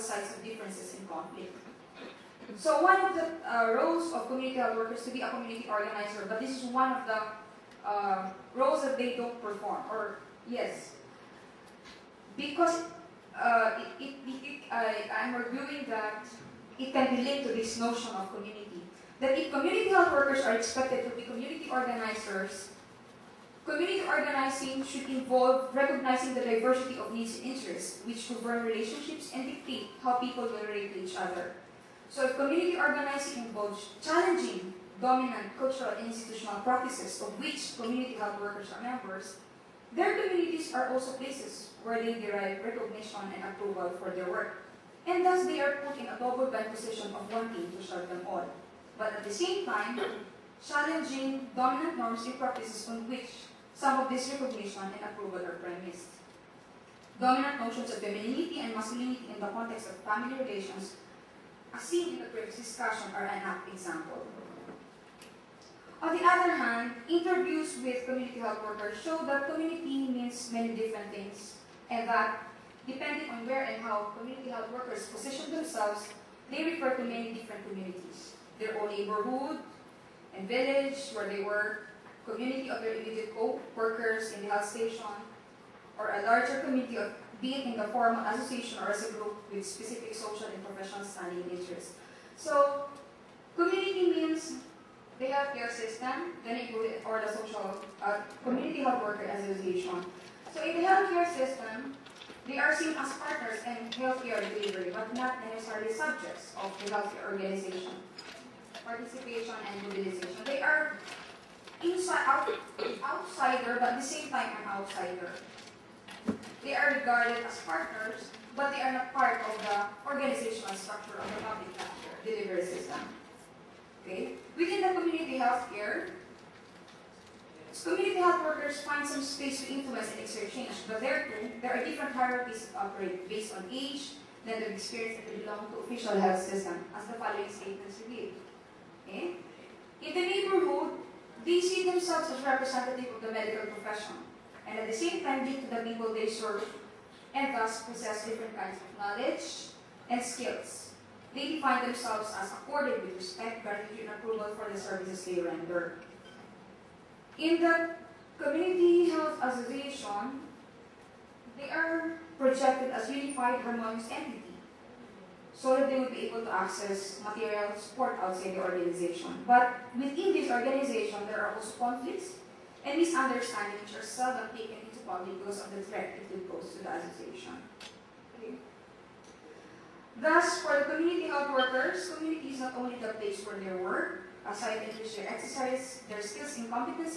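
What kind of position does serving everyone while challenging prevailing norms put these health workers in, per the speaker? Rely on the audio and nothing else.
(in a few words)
double-bind.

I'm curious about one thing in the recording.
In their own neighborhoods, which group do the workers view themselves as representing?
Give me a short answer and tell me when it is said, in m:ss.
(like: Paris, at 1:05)
the medical profession, at 2:23.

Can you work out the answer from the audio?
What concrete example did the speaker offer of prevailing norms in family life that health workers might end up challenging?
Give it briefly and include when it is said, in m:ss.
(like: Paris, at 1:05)
femininity and masculinity, at 0:57.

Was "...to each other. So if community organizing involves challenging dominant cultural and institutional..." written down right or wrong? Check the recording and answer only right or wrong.
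right.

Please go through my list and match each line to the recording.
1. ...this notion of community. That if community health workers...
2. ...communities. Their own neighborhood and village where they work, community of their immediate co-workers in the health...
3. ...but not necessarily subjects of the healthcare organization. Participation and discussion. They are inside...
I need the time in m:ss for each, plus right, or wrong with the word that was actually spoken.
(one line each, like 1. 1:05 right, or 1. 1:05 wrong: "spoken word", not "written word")
1. 0:17 right
2. 1:17 right
3. 1:44 wrong: "mobilization", not "discussion".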